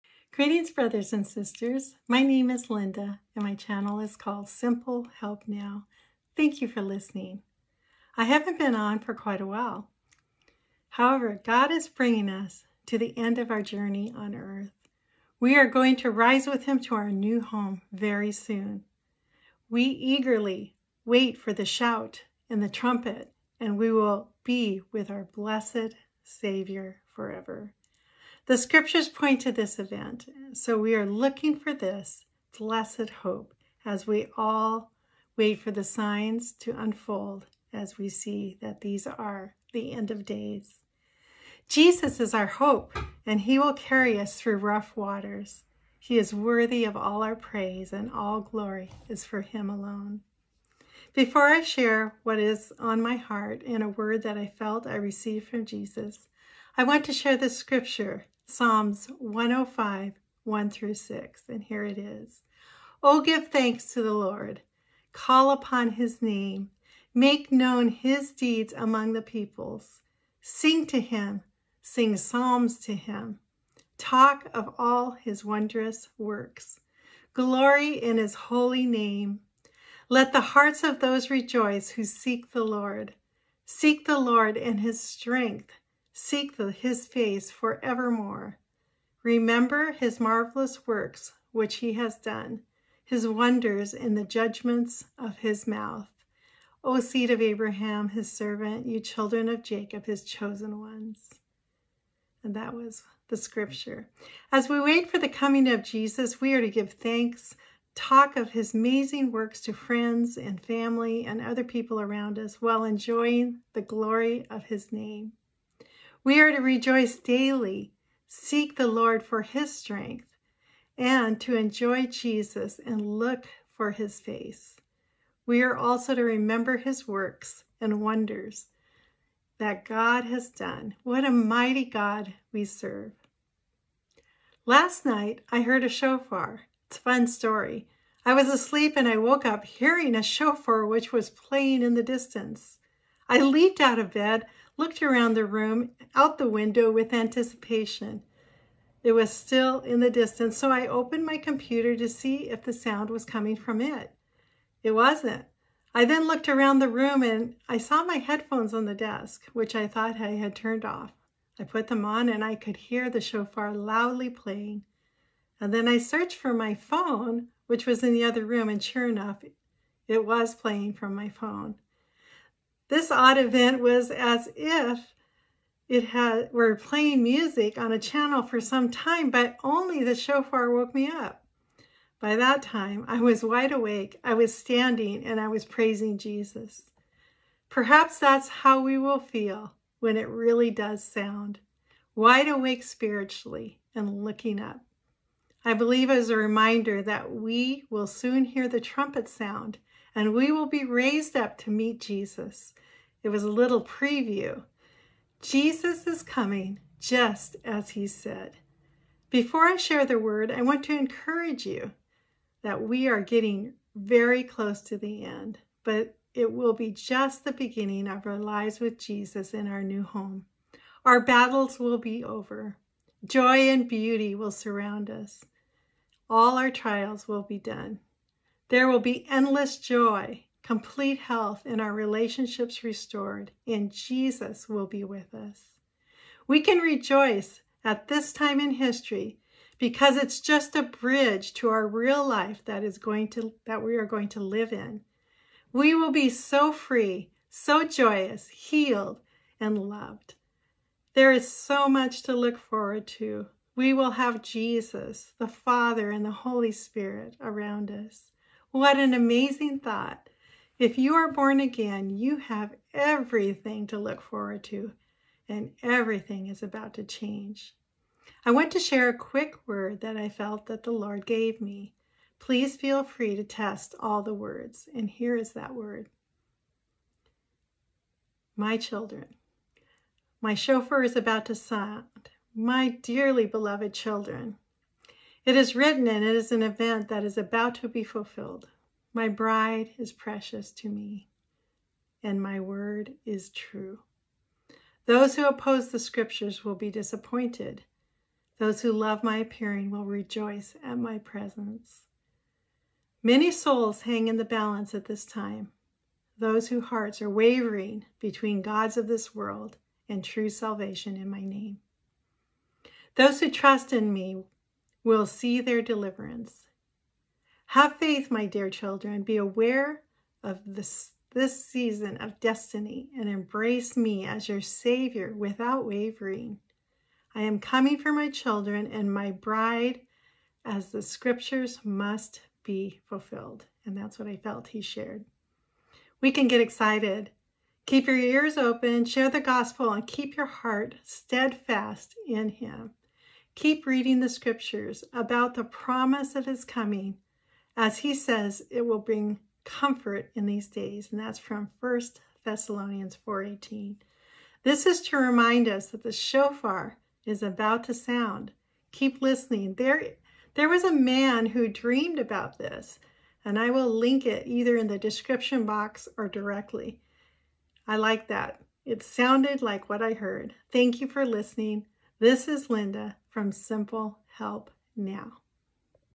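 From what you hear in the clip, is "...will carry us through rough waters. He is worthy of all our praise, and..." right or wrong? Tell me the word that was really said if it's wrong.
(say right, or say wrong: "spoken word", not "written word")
right.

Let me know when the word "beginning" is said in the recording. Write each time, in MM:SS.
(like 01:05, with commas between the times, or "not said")
03:37.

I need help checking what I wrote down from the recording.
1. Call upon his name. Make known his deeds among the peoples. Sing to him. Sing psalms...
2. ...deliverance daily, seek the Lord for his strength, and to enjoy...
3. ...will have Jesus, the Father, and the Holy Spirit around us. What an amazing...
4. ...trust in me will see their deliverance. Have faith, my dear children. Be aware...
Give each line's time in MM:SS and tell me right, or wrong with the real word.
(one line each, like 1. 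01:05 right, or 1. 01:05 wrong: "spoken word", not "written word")
1. 01:05 right
2. 01:56 wrong: "rejoice", not "deliverance"
3. 04:13 right
4. 05:13 right.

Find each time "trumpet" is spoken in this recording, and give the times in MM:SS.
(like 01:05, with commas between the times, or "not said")
00:22, 03:18.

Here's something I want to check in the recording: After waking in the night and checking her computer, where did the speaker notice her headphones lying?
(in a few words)
On the desk.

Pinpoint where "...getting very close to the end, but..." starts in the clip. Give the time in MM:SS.
03:33.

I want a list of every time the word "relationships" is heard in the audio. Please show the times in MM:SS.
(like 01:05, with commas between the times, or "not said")
03:51.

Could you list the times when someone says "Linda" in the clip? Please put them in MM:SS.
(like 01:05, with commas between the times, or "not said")
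00:02, 06:12.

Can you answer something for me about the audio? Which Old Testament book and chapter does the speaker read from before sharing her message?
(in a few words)
Psalm 105.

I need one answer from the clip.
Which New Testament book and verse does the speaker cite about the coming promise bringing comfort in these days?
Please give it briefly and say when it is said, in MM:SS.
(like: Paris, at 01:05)
1 Thessalonians 4:18, at 05:51.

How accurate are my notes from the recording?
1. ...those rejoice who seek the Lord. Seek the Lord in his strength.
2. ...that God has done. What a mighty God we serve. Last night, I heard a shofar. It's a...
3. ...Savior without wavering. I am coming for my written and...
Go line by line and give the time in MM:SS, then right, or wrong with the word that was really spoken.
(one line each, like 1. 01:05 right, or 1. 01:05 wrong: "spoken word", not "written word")
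1. 01:20 right
2. 02:09 right
3. 05:24 wrong: "children", not "written".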